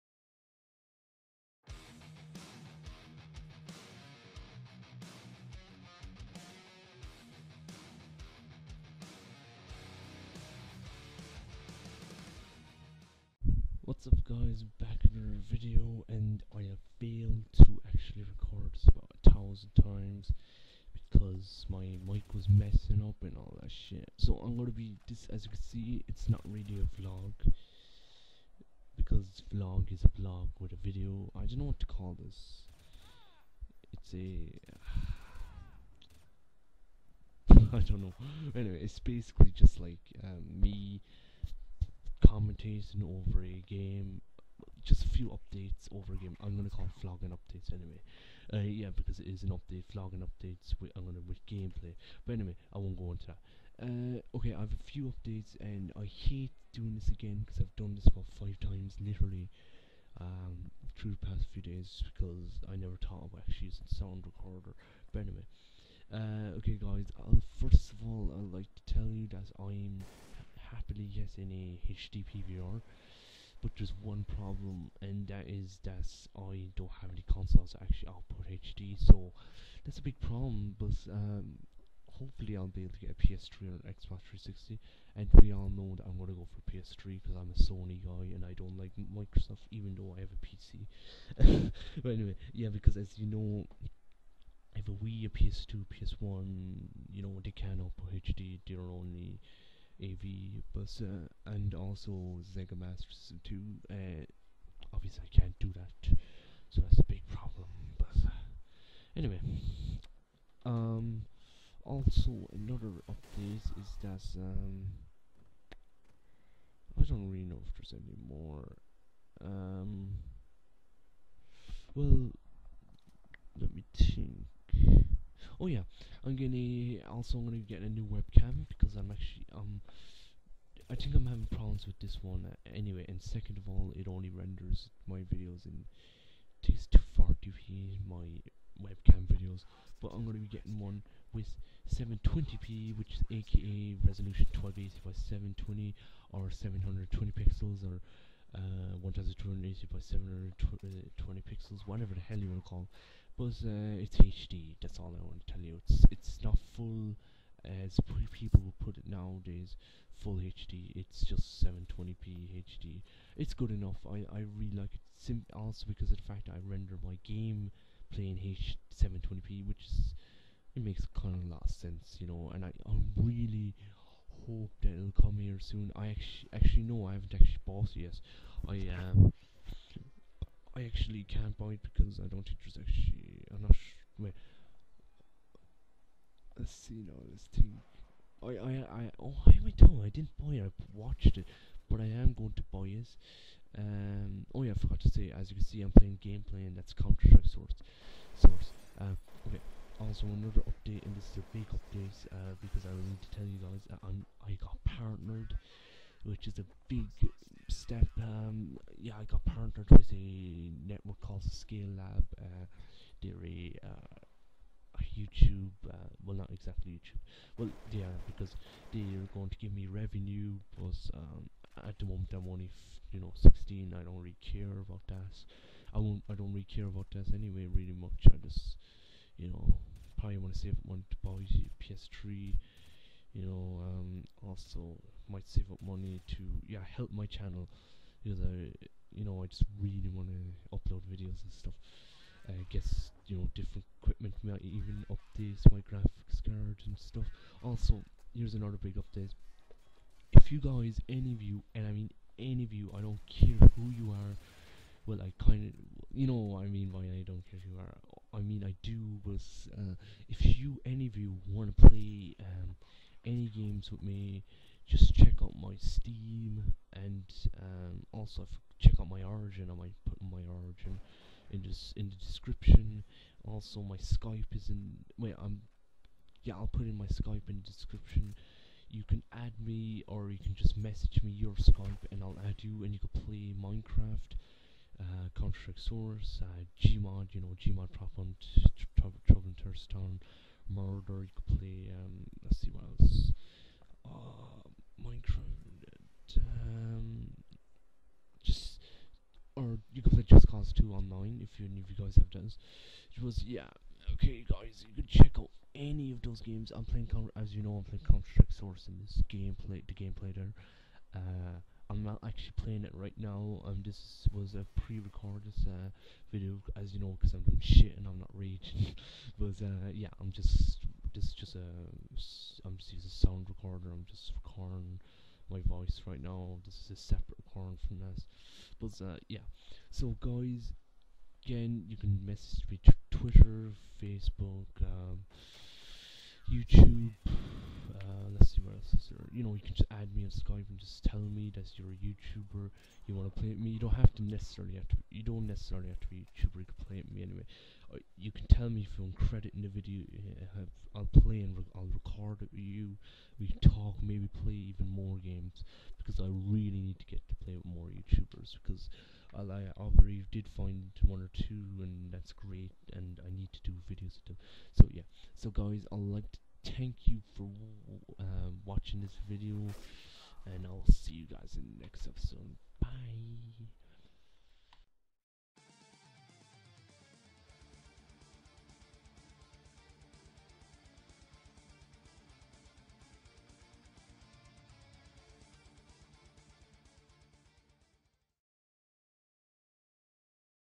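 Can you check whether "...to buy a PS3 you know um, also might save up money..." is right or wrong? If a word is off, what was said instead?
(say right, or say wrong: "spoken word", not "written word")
right.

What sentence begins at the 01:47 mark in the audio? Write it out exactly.
But uh, anyway, um, also another update is that um, I don't really know if there's any more.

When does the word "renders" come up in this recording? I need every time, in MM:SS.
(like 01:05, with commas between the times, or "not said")
02:14, 02:46.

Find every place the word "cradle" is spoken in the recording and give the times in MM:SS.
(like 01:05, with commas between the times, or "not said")
not said.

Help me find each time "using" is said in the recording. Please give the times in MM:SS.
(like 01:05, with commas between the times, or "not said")
01:03, 05:22.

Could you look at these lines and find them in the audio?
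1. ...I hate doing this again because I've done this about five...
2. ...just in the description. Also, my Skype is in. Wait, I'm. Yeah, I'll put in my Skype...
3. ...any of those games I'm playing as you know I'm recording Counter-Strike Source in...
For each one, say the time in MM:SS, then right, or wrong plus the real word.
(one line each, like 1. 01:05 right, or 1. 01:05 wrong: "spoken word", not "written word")
1. 00:55 right
2. 04:31 right
3. 05:05 wrong: "playing", not "recording".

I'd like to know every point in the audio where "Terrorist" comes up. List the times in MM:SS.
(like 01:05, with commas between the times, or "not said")
04:49.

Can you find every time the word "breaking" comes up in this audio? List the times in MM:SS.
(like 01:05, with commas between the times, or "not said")
not said.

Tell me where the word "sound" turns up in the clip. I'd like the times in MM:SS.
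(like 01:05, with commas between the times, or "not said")
01:03, 05:23.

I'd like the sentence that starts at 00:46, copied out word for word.
I'm gonna call vlogging updates anyway.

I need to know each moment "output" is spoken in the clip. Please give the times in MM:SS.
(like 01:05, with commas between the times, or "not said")
01:18, 01:37.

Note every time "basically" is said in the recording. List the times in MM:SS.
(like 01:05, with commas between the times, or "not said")
00:38.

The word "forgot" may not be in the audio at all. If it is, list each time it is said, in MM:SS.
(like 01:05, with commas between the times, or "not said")
03:14.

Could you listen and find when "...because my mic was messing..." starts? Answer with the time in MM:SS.
00:21.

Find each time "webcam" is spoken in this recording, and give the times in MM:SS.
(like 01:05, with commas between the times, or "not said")
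02:08, 02:18.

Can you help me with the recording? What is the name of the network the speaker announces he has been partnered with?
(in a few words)
ScaleLab.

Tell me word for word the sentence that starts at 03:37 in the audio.
Well, yeah, because they're going to give me revenue, but um, at the moment I'm only, you know, 16.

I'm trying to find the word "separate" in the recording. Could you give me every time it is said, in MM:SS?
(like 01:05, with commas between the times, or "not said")
05:27.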